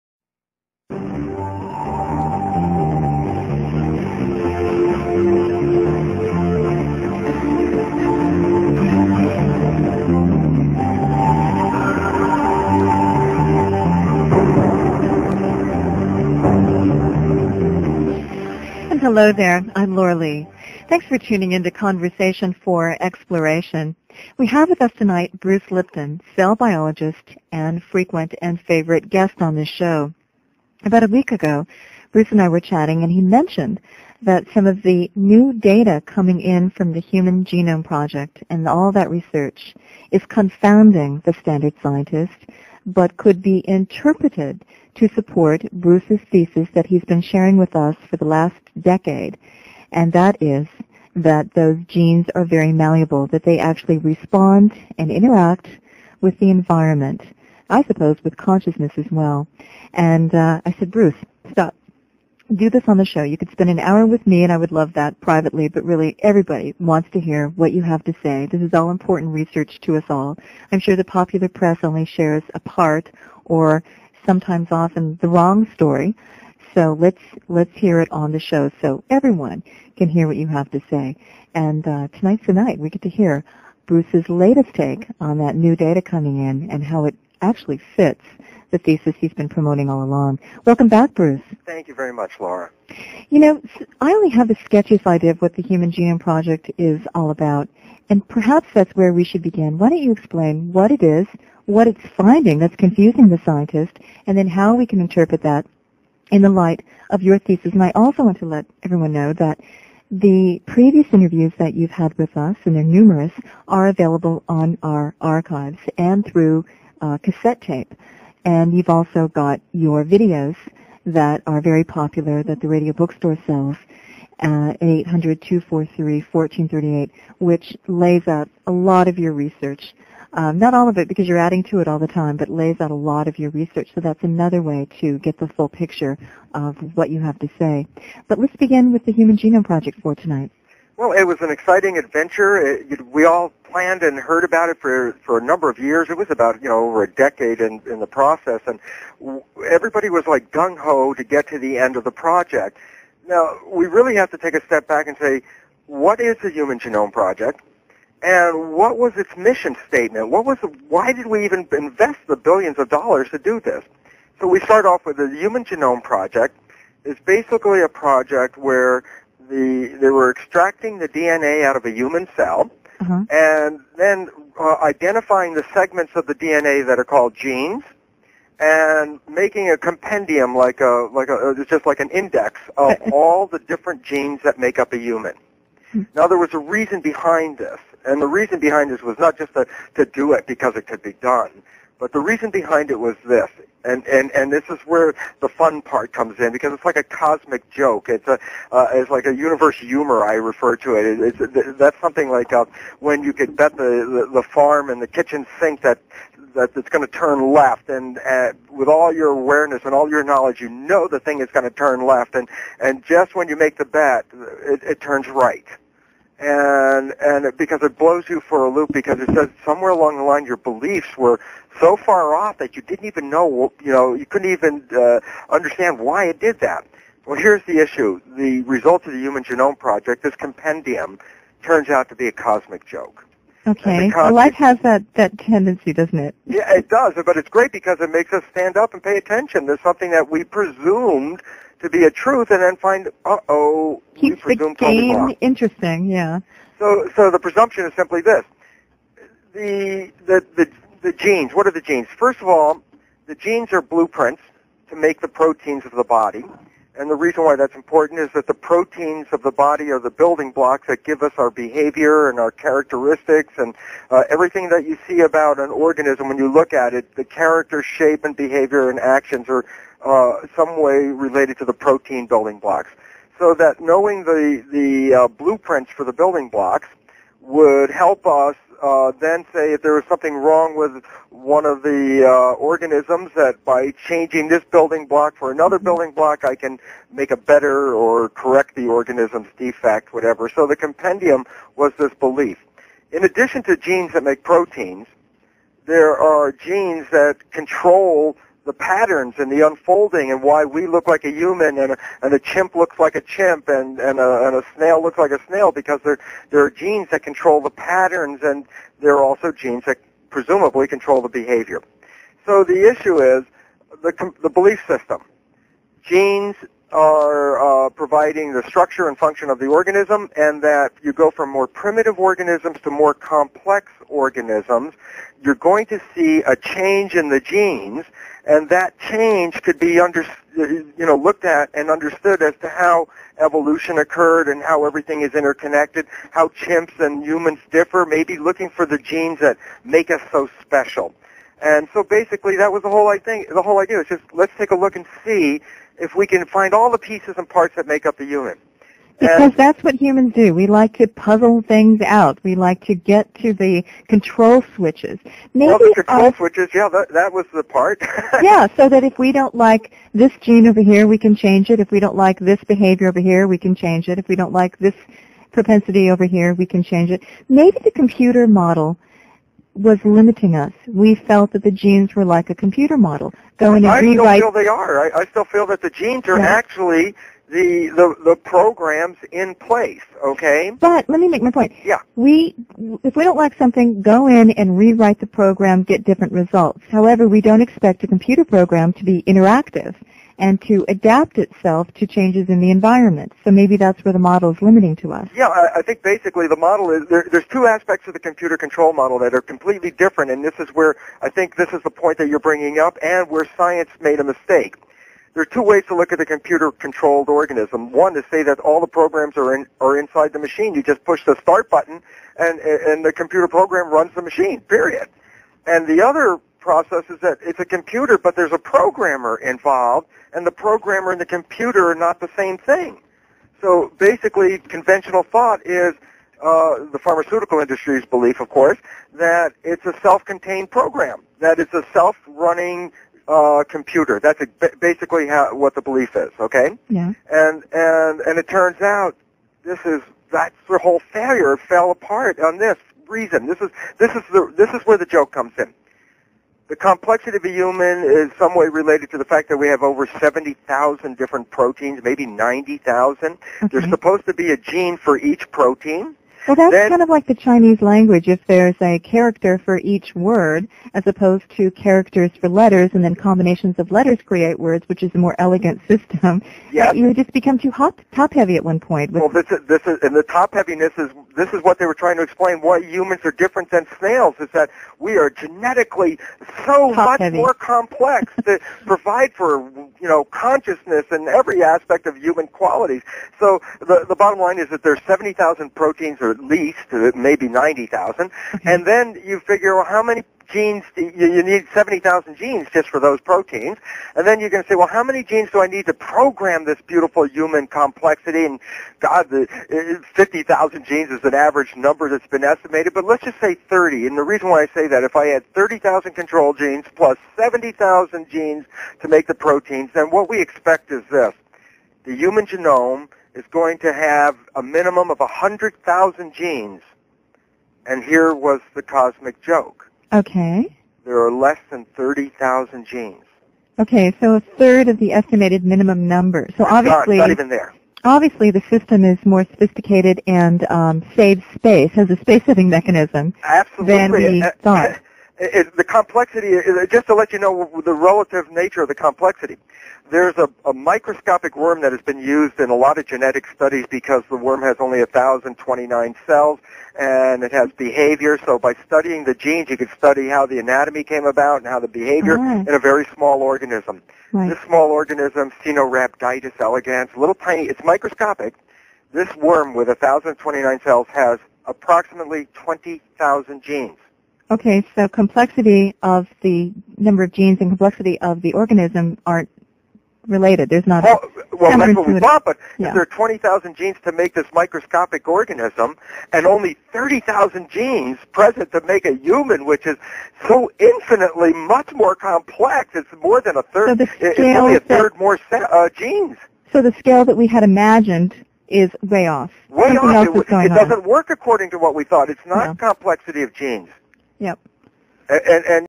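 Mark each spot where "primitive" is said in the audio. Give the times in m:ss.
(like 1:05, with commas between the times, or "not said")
5:21.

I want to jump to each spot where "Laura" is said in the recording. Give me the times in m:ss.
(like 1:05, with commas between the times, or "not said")
0:19, 1:32.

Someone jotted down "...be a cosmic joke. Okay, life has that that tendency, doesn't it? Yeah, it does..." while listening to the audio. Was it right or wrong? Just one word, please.
right.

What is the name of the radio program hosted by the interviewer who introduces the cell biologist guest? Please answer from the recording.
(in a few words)
Conversation for Exploration.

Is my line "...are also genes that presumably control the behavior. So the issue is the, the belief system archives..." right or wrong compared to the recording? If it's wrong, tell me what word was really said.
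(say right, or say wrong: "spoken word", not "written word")
wrong: "genes", not "archives".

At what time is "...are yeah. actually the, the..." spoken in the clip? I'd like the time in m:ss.
6:16.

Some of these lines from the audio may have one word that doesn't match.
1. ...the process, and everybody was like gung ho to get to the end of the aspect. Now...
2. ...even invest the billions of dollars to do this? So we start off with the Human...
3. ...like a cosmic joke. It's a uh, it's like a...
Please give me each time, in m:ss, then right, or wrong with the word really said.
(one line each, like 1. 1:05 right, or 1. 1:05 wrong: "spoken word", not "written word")
1. 2:27 wrong: "project", not "aspect"
2. 2:41 right
3. 3:16 right.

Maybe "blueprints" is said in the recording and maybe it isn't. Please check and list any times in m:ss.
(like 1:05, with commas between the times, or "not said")
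4:13, 4:35.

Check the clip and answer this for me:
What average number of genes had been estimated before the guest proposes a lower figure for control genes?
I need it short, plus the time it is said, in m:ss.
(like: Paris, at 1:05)
50,000, at 8:20.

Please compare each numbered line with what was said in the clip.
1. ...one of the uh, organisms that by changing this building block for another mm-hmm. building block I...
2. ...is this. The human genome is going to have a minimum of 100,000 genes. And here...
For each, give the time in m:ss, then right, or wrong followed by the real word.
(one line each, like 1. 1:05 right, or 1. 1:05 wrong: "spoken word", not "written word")
1. 4:41 right
2. 8:30 right.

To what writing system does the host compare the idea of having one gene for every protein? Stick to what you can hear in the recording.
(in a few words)
Chinese language.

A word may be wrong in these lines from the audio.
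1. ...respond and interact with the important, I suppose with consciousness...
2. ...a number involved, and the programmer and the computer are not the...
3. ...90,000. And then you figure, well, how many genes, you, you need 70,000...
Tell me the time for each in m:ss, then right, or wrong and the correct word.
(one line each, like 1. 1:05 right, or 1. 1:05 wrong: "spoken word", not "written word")
1. 0:53 wrong: "environment", not "important"
2. 6:58 wrong: "programmer", not "number"
3. 8:07 right.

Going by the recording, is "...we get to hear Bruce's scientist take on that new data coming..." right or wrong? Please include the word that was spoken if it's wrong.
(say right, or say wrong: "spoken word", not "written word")
wrong: "latest", not "scientist".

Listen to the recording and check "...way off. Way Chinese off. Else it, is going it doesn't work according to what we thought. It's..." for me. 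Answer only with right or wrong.
wrong.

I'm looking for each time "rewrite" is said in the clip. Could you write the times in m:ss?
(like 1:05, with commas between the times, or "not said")
6:14, 6:24.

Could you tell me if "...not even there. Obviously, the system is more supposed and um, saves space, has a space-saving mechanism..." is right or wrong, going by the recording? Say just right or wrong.
wrong.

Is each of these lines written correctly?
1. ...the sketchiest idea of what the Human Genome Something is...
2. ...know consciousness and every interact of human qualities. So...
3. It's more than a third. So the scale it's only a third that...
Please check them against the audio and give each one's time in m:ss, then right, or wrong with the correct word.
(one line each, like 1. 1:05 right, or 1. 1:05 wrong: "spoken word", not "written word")
1. 1:34 wrong: "Project", not "Something"
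2. 8:00 wrong: "aspect", not "interact"
3. 9:42 right.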